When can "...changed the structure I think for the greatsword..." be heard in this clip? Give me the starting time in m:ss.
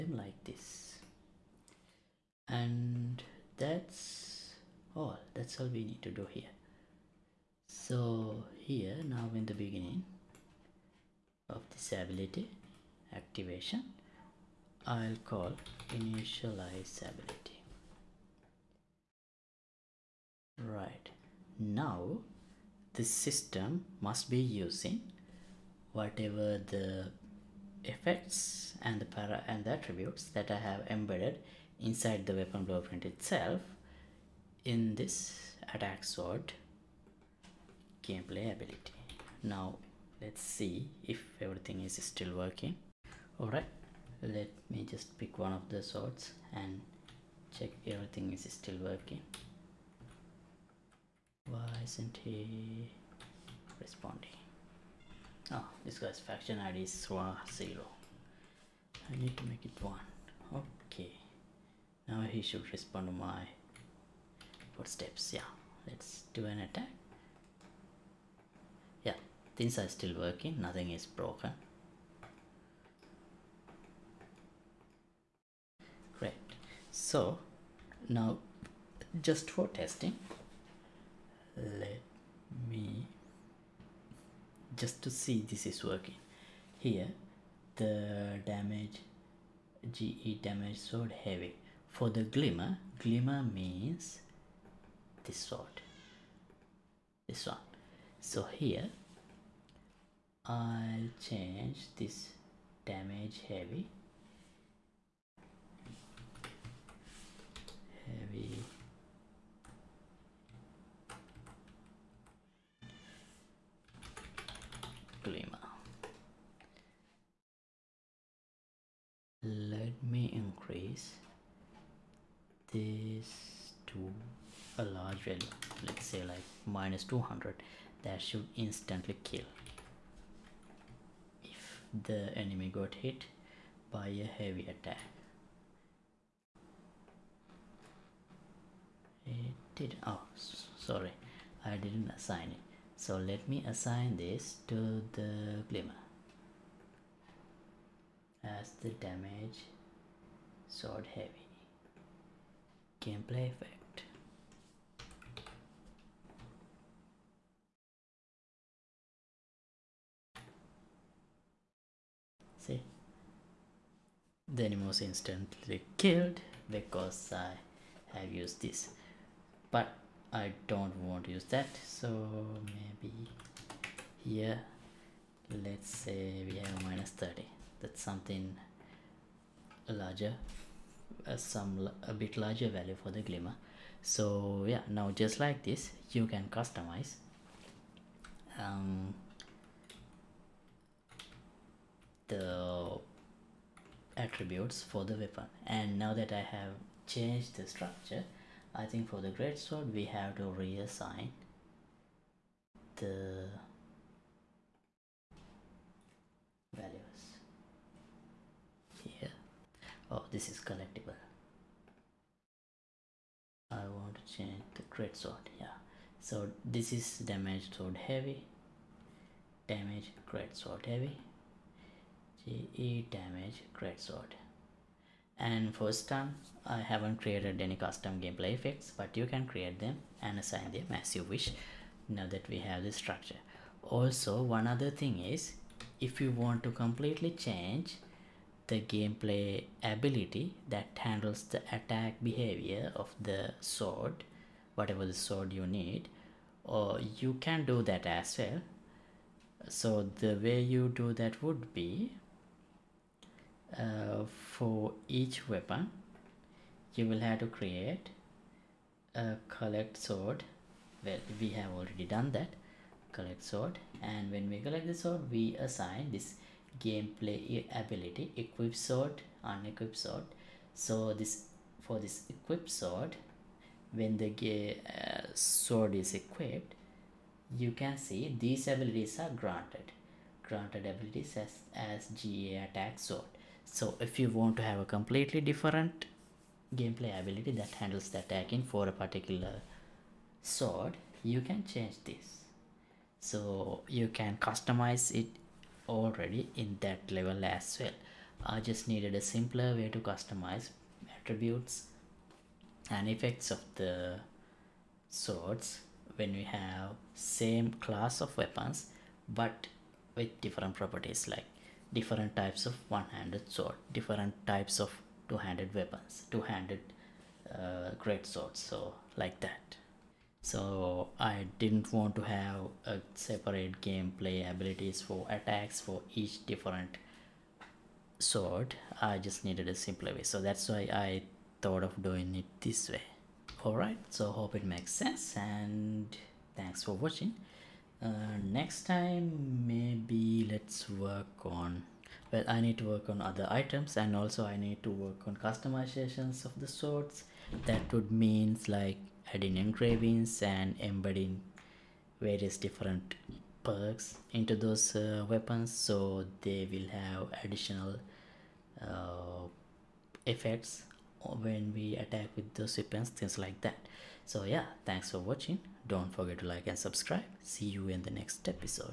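3:17.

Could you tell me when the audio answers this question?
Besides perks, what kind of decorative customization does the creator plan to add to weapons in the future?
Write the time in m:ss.
5:49.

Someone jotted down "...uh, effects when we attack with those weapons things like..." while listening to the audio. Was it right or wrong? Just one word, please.
right.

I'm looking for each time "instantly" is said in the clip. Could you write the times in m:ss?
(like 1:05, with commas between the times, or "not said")
2:08, 2:45.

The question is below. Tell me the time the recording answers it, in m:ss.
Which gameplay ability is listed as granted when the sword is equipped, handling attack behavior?
4:42.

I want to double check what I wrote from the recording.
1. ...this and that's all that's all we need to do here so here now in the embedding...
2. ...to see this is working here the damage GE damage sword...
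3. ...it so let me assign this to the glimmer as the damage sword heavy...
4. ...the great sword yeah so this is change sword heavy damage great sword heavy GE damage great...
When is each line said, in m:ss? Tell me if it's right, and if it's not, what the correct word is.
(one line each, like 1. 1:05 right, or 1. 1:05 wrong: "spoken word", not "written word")
1. 0:00 wrong: "beginning", not "embedding"
2. 1:25 right
3. 2:22 right
4. 3:34 wrong: "damage", not "change".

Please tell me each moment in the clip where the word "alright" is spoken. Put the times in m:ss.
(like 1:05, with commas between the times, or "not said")
0:43, 5:33.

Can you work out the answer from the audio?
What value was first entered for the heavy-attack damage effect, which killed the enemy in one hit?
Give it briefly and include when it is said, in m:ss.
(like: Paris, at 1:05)
-200, at 2:06.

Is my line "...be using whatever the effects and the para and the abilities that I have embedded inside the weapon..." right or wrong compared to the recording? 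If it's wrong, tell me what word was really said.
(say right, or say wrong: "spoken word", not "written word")
wrong: "attributes", not "abilities".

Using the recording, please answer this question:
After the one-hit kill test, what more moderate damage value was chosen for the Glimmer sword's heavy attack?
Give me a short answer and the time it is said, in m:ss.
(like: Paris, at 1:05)
-30, at 2:56.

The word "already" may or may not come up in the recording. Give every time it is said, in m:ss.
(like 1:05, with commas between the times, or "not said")
4:21, 4:55.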